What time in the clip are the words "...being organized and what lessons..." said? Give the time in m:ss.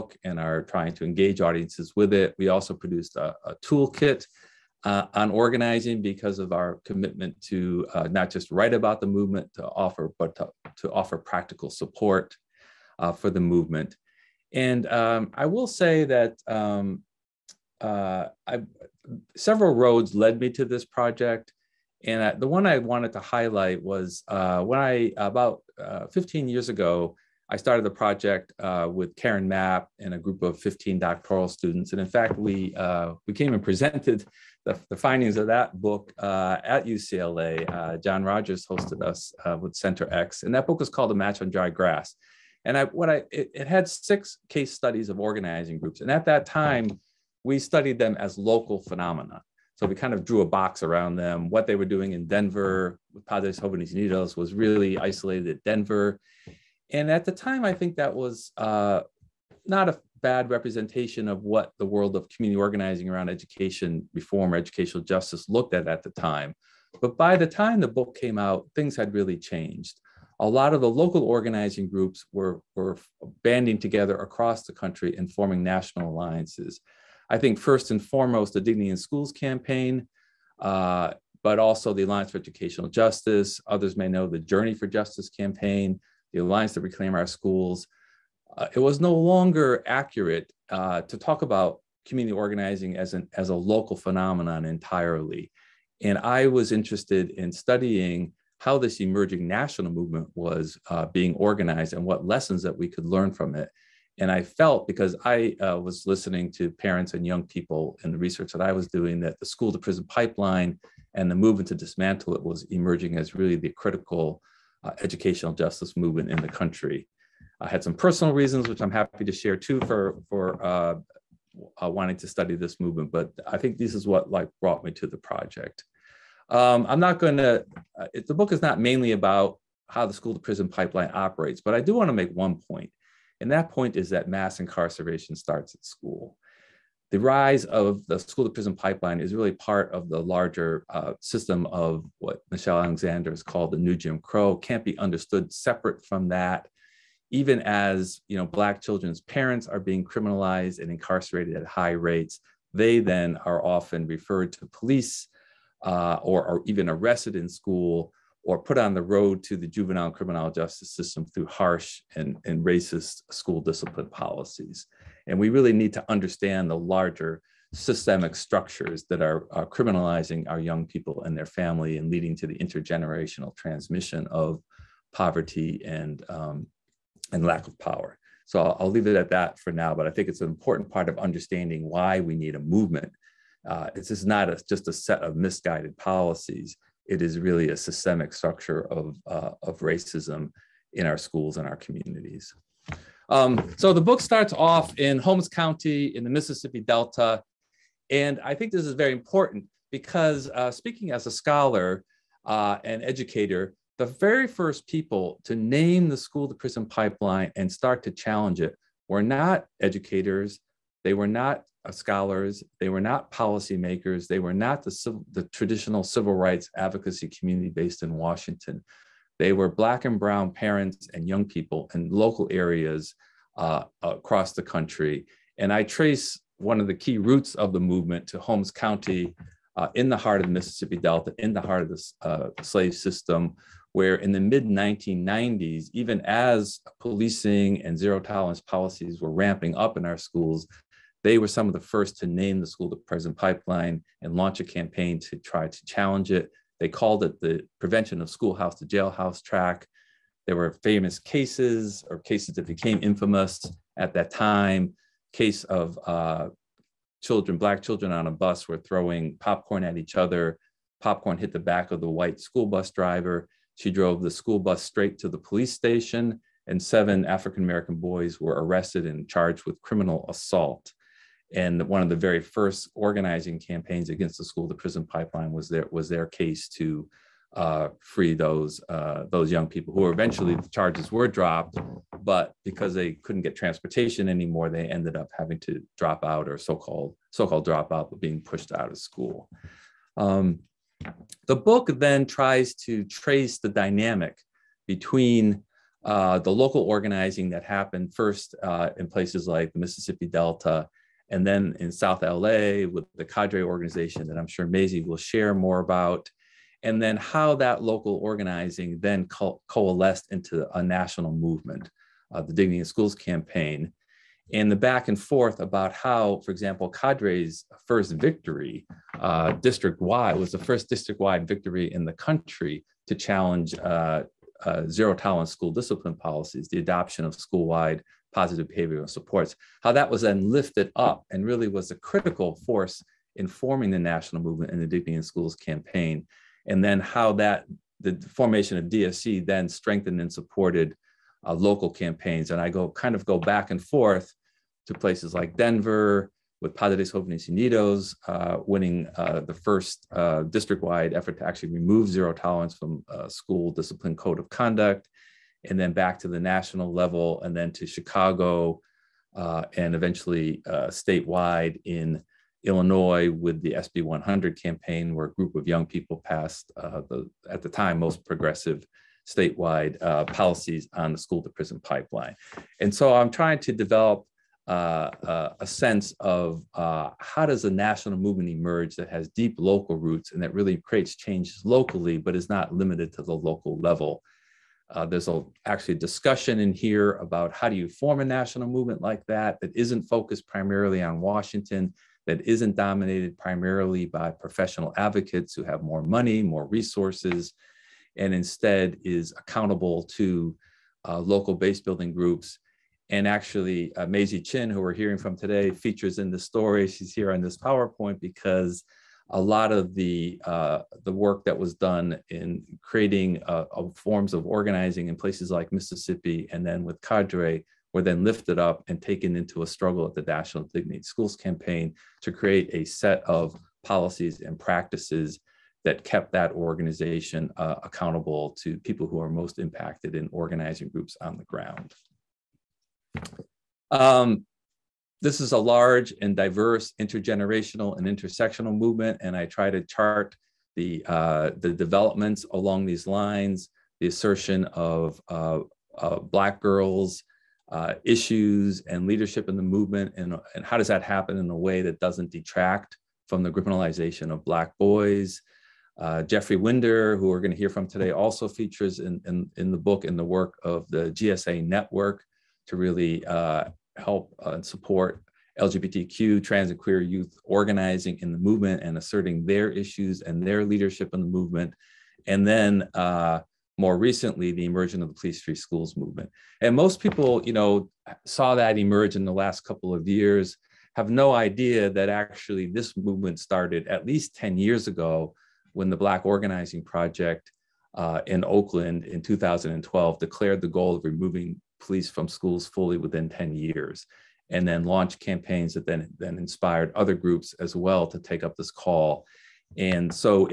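1:41.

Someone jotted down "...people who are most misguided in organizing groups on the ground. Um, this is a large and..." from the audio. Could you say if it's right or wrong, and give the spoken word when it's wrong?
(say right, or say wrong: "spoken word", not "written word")
wrong: "impacted", not "misguided".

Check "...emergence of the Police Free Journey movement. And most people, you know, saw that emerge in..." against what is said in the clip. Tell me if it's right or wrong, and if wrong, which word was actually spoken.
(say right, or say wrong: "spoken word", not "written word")
wrong: "Schools", not "Journey".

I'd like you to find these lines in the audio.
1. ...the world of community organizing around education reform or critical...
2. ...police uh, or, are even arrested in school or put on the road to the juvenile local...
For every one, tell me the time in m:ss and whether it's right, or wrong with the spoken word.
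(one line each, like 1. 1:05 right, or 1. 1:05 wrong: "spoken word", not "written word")
1. 1:01 wrong: "educational", not "critical"
2. 2:34 wrong: "criminal", not "local".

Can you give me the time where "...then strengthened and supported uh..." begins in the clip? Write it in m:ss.
5:39.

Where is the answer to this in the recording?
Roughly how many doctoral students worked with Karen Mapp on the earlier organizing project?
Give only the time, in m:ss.
0:30.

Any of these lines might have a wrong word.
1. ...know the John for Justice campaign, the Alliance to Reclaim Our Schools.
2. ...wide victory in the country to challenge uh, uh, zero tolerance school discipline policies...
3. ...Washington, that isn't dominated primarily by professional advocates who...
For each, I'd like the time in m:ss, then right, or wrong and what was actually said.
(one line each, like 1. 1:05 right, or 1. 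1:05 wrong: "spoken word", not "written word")
1. 1:24 wrong: "Journey", not "John"
2. 5:21 right
3. 6:31 right.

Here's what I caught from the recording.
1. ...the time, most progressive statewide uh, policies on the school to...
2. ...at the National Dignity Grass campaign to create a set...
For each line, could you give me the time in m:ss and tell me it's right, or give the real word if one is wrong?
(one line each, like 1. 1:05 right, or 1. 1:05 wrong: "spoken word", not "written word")
1. 6:07 right
2. 7:00 wrong: "Schools", not "Grass".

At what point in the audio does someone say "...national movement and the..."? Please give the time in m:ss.
5:33.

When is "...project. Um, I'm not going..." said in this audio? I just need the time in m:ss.
2:05.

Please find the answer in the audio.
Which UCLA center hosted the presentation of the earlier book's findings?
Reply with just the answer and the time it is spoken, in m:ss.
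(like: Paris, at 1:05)
Center X, at 0:39.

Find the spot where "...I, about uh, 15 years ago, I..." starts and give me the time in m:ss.
0:24.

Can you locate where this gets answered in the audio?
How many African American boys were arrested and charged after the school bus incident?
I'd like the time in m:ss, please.
4:26.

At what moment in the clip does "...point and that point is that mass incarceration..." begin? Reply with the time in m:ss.
2:12.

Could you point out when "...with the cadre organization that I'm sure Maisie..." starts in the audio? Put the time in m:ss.
5:02.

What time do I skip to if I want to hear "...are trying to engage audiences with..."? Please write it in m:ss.
0:00.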